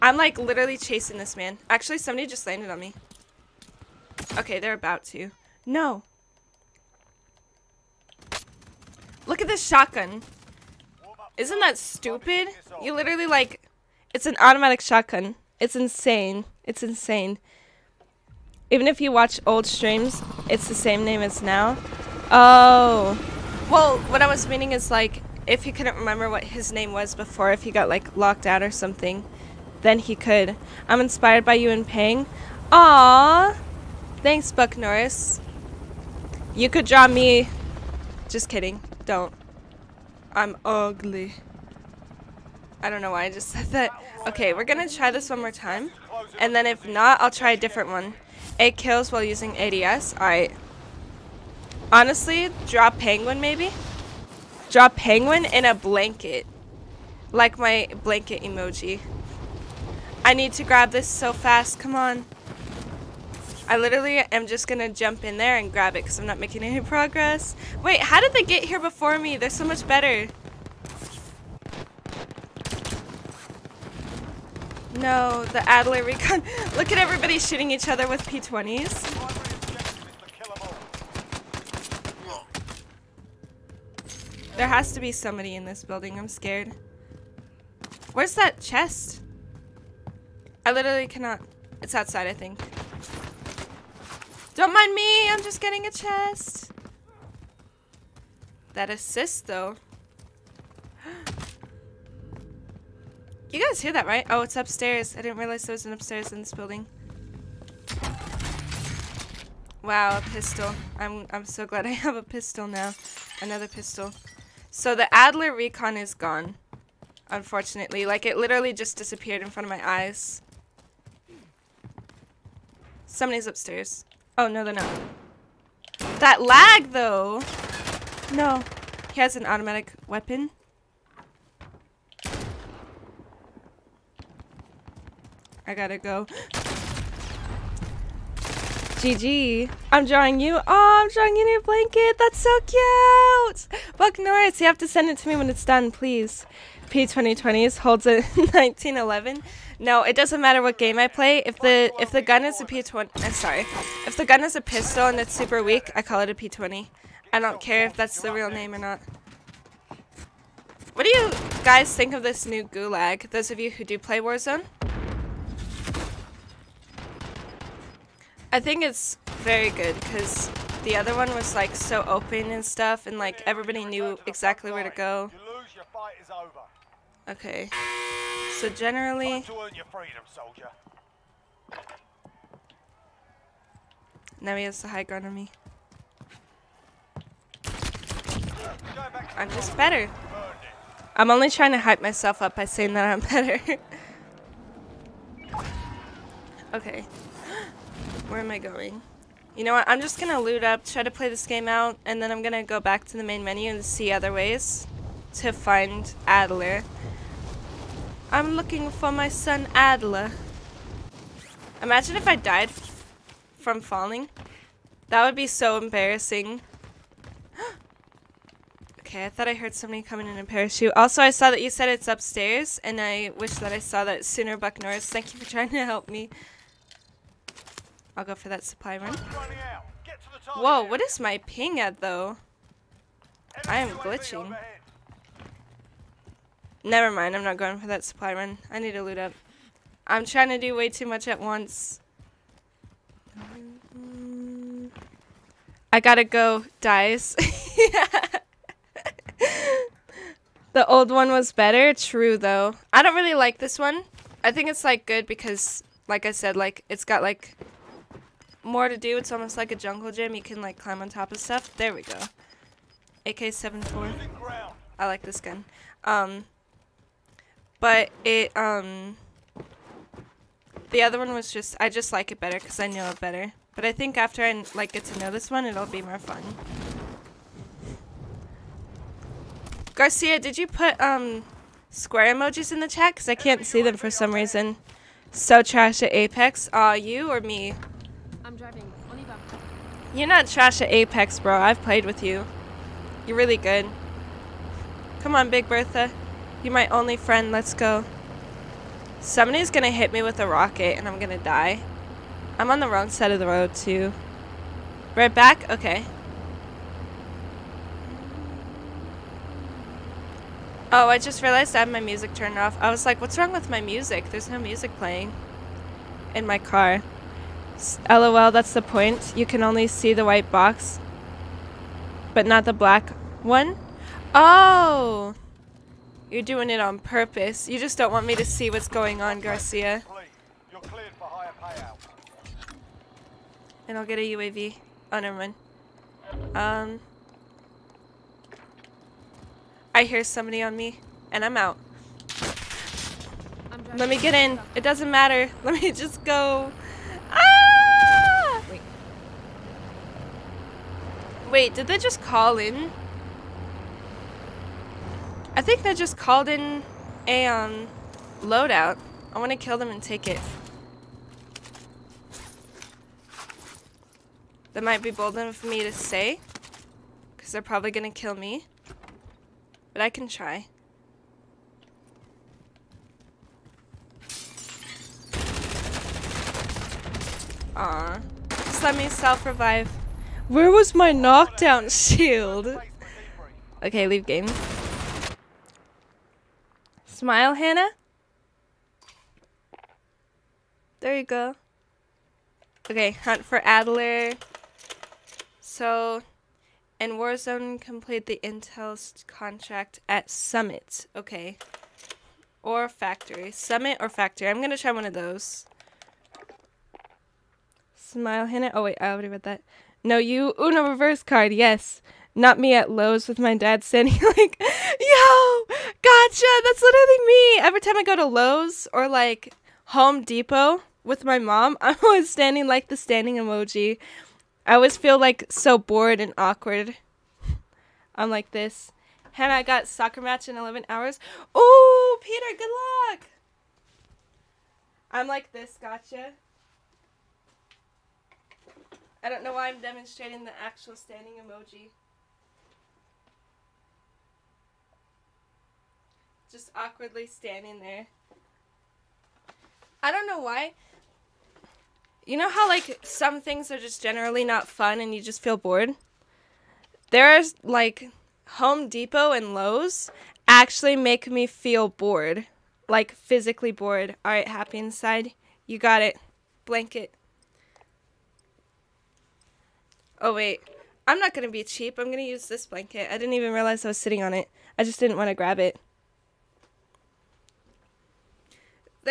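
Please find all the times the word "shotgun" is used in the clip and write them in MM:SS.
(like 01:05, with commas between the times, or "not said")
00:09, 00:14.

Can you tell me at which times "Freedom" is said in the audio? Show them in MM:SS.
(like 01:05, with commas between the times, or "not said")
02:59.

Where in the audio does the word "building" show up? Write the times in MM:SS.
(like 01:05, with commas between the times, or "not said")
01:25, 01:46.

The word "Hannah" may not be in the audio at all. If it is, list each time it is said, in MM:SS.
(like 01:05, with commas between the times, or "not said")
06:27, 06:48, 07:09.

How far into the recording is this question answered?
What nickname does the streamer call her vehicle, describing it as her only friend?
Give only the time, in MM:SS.
04:55.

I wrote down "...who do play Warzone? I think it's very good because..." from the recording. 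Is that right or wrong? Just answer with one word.
right.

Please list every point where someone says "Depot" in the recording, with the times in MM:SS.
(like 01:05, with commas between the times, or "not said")
07:00, 07:38.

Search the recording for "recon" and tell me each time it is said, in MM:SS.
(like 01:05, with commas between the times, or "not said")
01:16, 01:55.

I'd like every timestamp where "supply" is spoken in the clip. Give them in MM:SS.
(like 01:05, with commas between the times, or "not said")
03:48, 03:58.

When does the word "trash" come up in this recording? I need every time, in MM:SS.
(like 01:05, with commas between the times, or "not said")
04:45, 04:50.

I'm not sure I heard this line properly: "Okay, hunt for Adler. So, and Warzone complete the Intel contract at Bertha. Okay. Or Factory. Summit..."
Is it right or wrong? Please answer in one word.
wrong.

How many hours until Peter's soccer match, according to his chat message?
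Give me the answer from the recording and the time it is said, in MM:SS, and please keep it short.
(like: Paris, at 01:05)
11, at 07:10.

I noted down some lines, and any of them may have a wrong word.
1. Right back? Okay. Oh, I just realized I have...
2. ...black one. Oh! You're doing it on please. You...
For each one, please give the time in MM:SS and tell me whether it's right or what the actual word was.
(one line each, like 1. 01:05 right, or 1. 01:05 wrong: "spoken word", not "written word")
1. 05:05 right
2. 05:22 wrong: "purpose", not "please".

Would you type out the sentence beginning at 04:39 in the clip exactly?
Garcia, did you put, um, square emojis in the chat?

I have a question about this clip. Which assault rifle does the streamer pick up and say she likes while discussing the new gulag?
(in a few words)
AK-74.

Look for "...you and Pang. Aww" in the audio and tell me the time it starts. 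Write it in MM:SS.
00:31.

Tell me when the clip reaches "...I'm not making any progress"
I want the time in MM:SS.
01:06.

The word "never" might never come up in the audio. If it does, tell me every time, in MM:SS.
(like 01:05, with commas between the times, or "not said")
03:56, 05:35.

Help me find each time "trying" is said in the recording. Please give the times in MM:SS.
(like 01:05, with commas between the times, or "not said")
03:11, 03:45, 04:00.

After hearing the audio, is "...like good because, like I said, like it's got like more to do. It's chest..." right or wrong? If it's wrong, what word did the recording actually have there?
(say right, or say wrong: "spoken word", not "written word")
wrong: "almost", not "chest".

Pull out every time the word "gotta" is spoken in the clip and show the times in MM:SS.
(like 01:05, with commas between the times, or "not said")
02:15, 04:05.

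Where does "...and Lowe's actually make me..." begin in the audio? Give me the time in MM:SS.
07:39.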